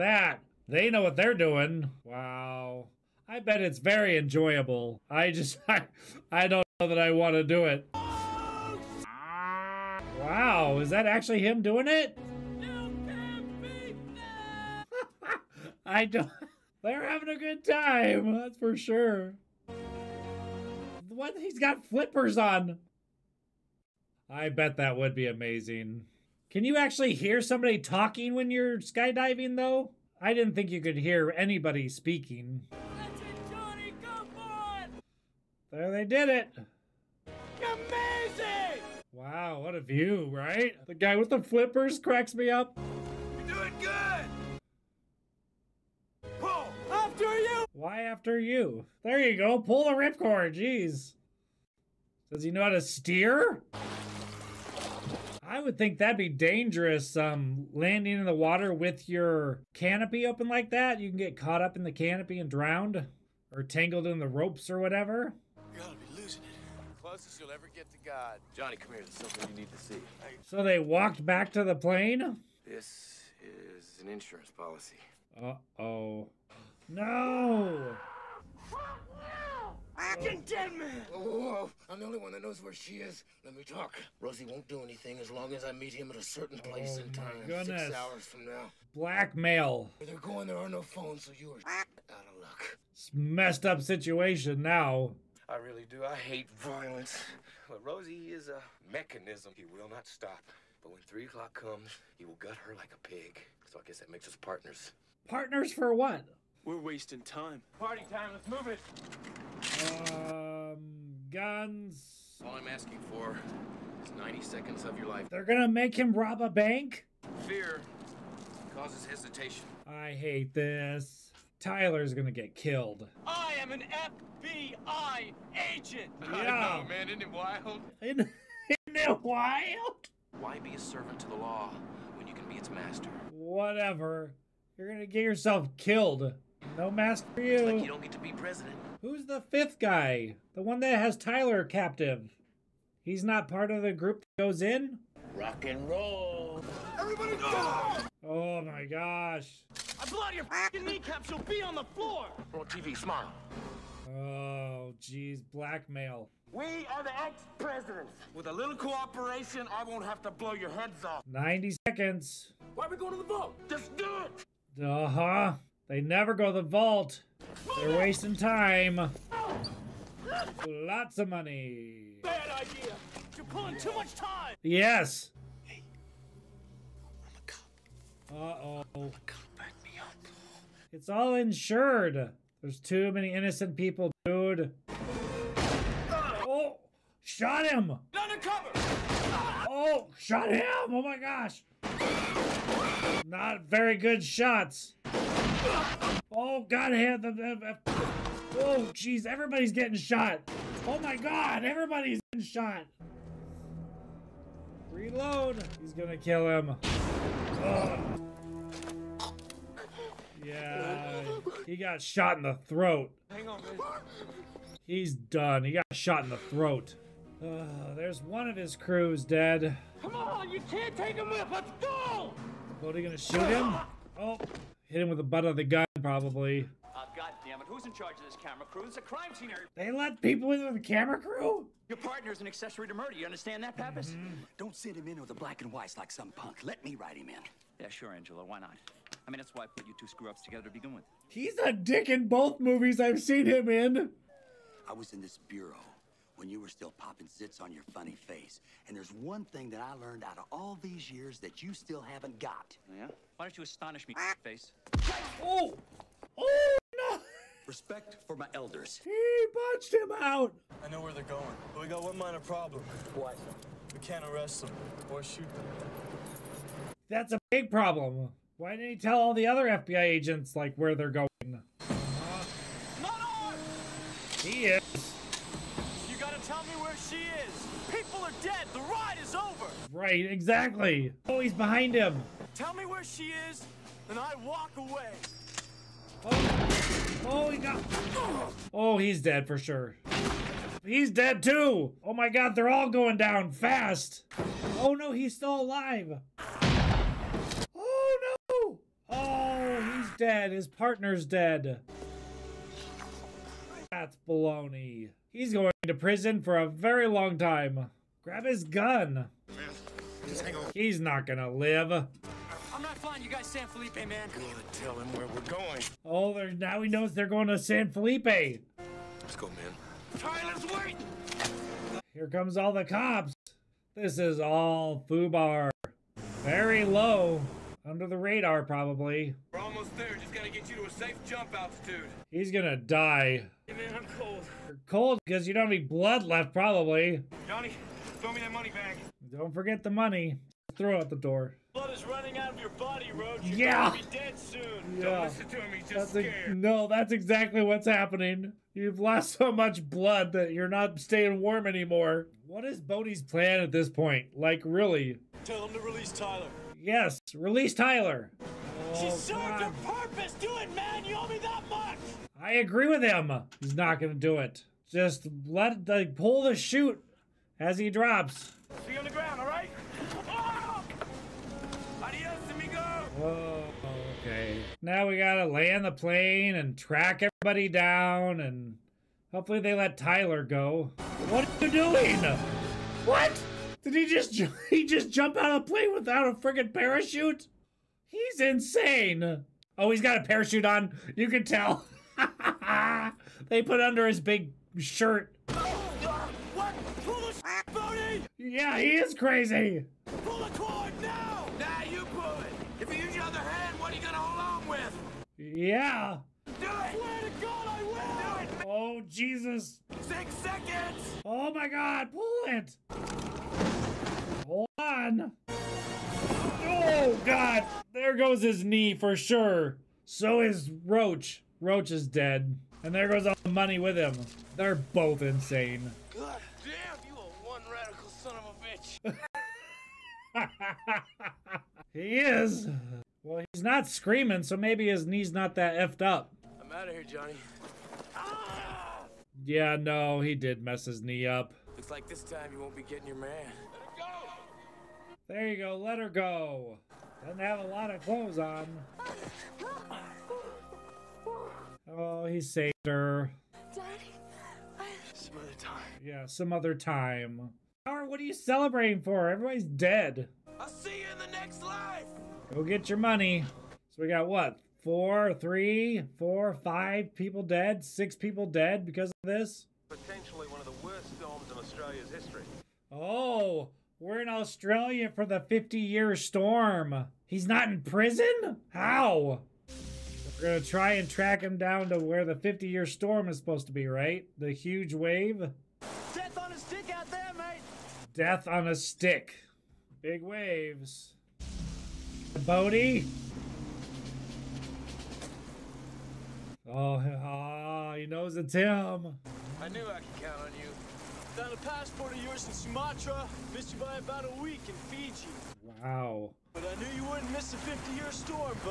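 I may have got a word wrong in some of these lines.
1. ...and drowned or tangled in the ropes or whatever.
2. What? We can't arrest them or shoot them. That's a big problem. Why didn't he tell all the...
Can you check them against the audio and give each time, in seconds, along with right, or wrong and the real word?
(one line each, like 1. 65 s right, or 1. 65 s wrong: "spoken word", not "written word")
1. 62 s right
2. 263 s right.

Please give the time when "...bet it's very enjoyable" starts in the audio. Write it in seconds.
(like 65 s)
3 s.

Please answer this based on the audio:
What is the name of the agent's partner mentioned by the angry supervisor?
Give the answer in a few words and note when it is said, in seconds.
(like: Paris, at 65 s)
Pappas, at 233 s.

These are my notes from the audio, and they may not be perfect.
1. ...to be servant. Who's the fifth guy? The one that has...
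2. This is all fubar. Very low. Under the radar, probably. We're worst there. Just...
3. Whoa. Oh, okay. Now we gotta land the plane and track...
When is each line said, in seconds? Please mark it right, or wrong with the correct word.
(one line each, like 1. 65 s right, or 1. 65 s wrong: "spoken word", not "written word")
1. 138 s wrong: "president", not "servant"
2. 323 s wrong: "almost", not "worst"
3. 373 s right.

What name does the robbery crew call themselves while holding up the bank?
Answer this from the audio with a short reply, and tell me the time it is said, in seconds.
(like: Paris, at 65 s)
The ex-presidents, at 157 s.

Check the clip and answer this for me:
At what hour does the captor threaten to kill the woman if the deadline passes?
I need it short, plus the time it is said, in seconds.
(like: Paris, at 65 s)
3 o'clock, at 101 s.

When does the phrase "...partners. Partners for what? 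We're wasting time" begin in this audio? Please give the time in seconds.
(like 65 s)
104 s.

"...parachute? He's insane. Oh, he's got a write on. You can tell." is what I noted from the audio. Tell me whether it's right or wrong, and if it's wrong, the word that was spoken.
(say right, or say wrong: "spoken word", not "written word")
wrong: "parachute", not "write".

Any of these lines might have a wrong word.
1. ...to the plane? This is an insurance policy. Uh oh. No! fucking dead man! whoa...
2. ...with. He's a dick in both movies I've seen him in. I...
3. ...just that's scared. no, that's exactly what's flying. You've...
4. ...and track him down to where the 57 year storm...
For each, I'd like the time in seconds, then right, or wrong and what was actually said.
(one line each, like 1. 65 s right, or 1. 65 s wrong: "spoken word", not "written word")
1. 71 s right
2. 240 s right
3. 345 s wrong: "happening", not "flying"
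4. 480 s wrong: "50", not "57".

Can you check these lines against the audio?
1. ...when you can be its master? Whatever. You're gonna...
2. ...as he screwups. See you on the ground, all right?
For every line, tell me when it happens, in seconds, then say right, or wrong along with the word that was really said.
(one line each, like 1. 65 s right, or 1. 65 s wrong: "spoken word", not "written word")
1. 132 s right
2. 367 s wrong: "drops", not "screwups".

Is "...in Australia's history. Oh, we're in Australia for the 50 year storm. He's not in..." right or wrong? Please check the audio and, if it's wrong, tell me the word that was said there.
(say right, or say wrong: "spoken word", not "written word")
right.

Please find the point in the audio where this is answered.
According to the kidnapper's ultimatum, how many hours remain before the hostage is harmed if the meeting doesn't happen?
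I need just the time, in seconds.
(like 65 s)
87 s.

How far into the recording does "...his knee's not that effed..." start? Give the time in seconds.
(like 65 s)
434 s.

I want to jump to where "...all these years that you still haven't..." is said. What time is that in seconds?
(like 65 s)
250 s.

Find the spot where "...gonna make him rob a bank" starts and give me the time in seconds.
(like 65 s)
115 s.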